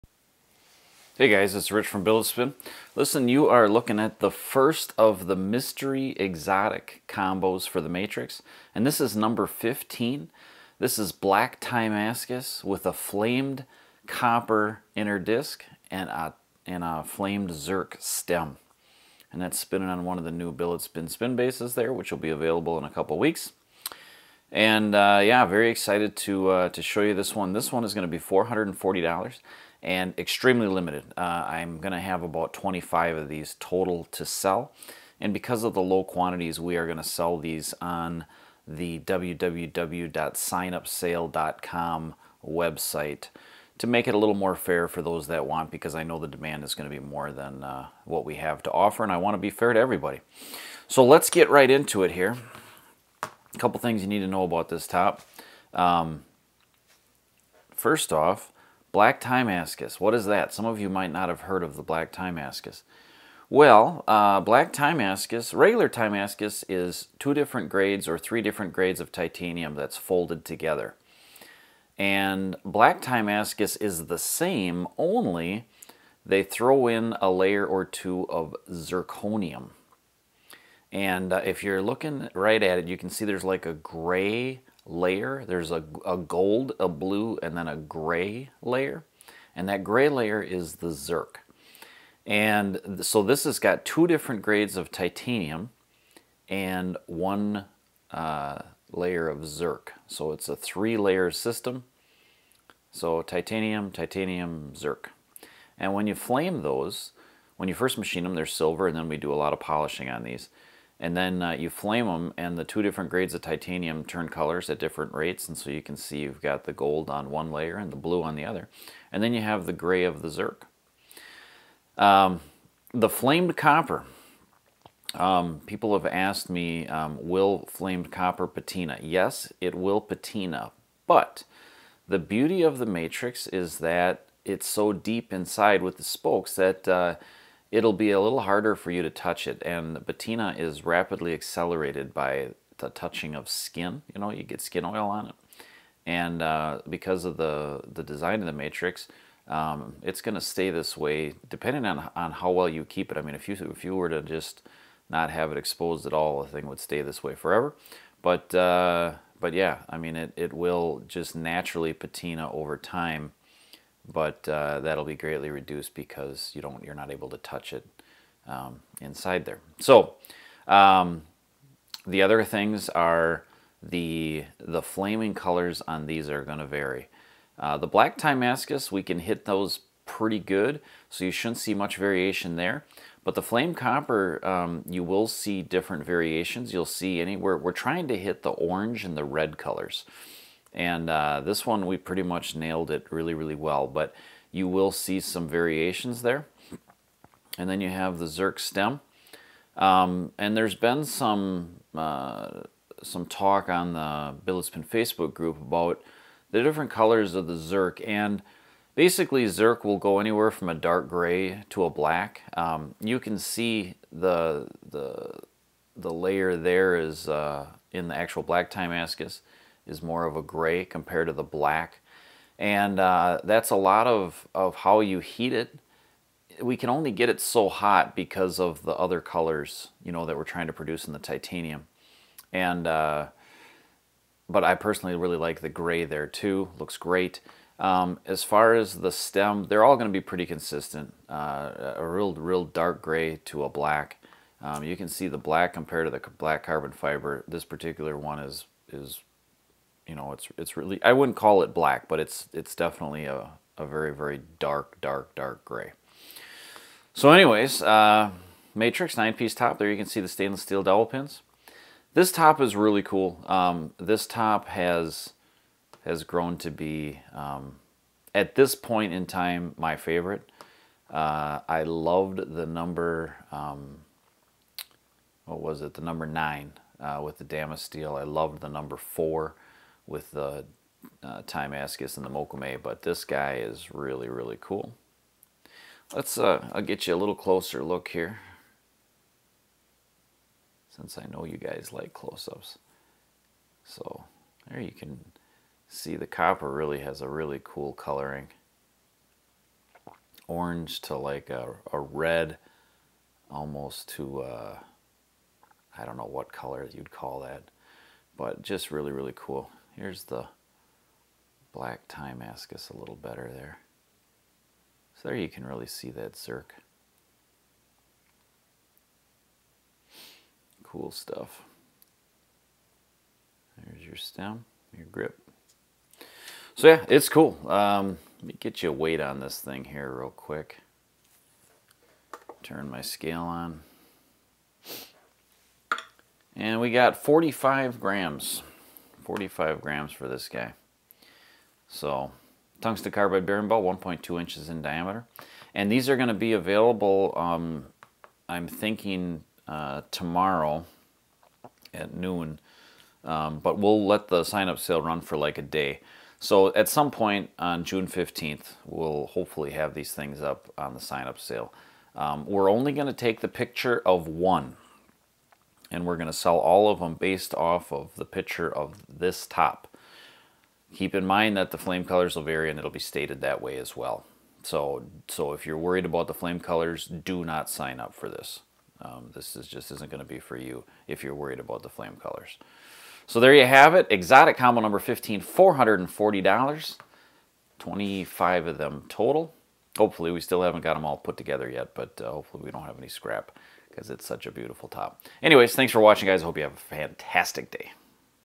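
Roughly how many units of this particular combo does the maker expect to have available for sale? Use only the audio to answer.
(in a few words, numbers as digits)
25.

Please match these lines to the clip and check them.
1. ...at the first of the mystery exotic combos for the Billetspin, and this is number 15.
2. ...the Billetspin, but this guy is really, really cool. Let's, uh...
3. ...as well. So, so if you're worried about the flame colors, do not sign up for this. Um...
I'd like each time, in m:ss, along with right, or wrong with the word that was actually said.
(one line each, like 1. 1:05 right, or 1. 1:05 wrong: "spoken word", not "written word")
1. 0:03 wrong: "Matrix", not "Billetspin"
2. 4:41 wrong: "Mokume", not "Billetspin"
3. 6:13 right.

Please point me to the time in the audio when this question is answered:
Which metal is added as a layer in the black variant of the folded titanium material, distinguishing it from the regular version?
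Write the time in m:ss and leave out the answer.
1:18.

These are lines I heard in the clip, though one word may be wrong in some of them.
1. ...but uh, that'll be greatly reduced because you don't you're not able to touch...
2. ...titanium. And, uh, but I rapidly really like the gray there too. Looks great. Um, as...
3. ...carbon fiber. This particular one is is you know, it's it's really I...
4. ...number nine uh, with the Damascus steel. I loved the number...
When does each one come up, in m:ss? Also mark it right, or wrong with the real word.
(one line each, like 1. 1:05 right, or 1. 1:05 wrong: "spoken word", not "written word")
1. 2:44 right
2. 3:51 wrong: "personally", not "rapidly"
3. 4:06 right
4. 4:36 right.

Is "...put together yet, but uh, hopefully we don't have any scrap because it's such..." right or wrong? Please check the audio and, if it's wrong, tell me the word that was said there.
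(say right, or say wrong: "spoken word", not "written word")
right.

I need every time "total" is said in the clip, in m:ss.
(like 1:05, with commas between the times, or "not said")
0:33, 6:29.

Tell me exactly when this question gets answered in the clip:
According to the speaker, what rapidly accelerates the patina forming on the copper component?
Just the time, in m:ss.
2:22.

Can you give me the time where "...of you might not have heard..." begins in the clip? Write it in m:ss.
1:00.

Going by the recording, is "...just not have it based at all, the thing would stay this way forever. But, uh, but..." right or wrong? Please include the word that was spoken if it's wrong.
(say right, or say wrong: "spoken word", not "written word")
wrong: "exposed", not "based".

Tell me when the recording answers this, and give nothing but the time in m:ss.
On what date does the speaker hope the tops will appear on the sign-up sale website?
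5:57.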